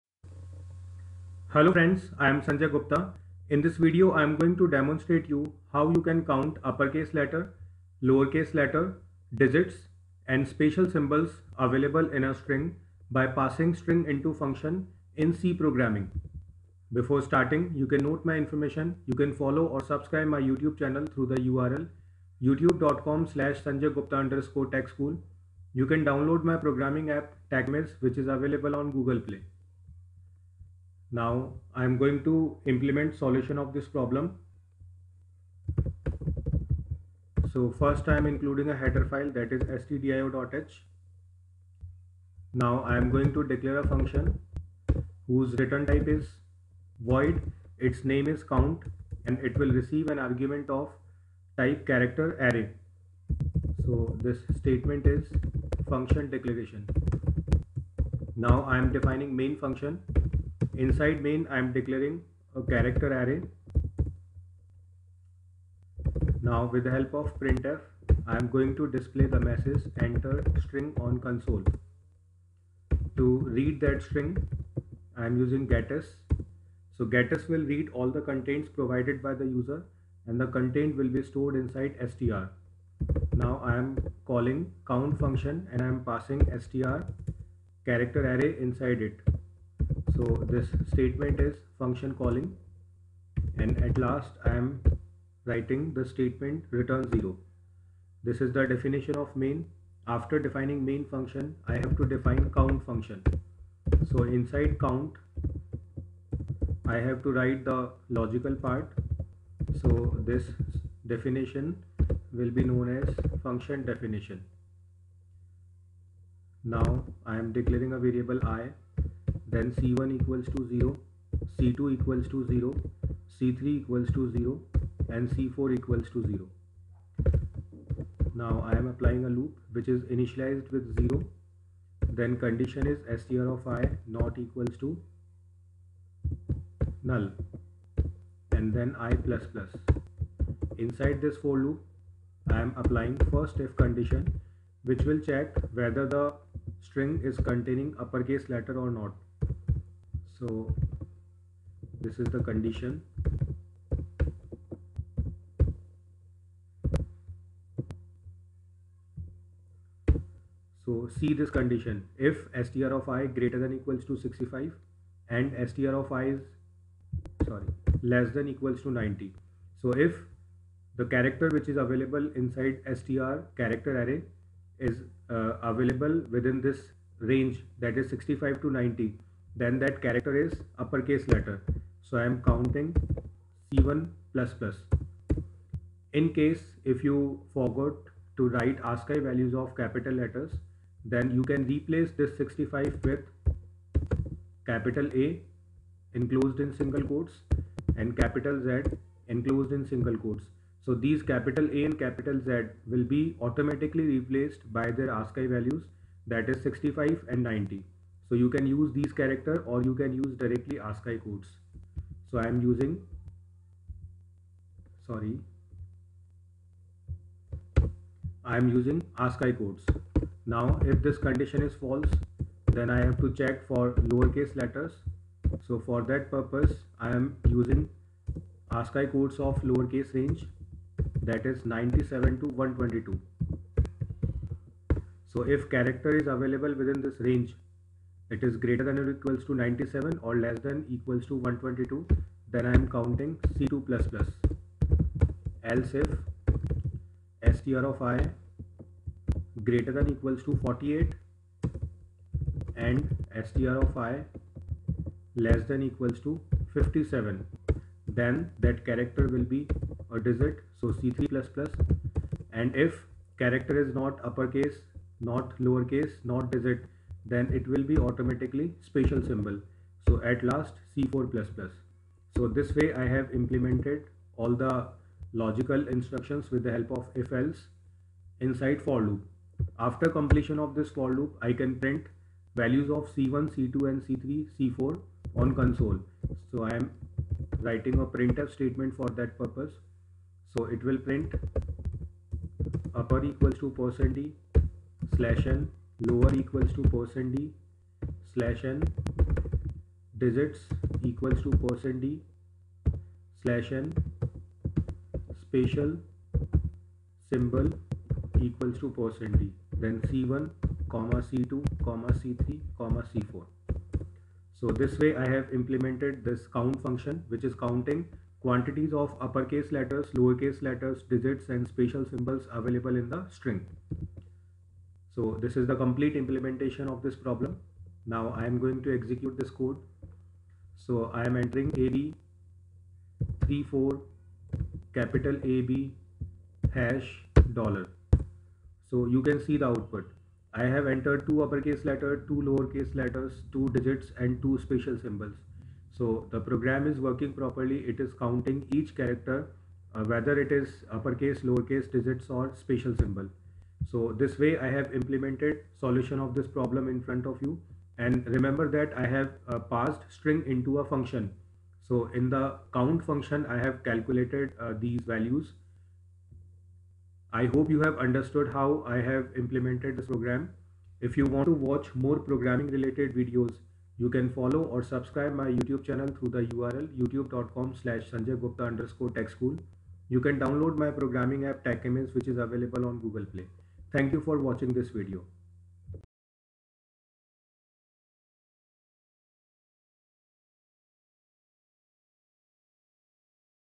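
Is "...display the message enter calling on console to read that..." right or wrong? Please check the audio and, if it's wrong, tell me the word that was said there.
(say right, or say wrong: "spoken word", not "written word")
wrong: "string", not "calling".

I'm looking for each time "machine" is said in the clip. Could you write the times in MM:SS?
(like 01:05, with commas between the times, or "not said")
not said.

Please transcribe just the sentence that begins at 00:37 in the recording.
So first I'm including a header file that is stdio.h.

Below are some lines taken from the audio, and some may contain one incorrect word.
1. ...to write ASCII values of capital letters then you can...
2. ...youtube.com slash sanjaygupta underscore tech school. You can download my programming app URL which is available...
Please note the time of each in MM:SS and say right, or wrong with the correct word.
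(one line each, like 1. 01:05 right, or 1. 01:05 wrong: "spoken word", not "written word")
1. 03:08 right
2. 06:17 wrong: "TechImage", not "URL".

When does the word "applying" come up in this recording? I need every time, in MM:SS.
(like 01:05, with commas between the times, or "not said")
02:08, 02:22.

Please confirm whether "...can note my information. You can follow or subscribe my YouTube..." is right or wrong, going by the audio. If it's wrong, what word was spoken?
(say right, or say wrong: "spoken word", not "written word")
right.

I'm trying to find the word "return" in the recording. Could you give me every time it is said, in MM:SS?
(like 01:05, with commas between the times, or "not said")
00:45, 01:36.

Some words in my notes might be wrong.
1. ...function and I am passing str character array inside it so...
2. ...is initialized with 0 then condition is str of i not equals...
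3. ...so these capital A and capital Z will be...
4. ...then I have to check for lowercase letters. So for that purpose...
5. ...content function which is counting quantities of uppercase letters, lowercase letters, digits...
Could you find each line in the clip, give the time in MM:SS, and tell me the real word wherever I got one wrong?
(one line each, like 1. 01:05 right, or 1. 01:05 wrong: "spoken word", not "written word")
1. 01:25 right
2. 02:09 right
3. 03:20 right
4. 03:42 right
5. 05:16 wrong: "count", not "content".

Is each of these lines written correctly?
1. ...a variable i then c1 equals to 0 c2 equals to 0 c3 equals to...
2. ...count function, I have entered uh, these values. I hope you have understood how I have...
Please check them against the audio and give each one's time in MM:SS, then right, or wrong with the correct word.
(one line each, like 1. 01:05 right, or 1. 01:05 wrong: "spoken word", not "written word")
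1. 01:57 right
2. 06:02 wrong: "calculated", not "entered".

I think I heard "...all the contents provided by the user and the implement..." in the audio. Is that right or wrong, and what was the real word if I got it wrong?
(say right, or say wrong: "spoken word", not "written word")
wrong: "content", not "implement".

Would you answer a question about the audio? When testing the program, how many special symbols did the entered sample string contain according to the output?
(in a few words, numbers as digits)
2.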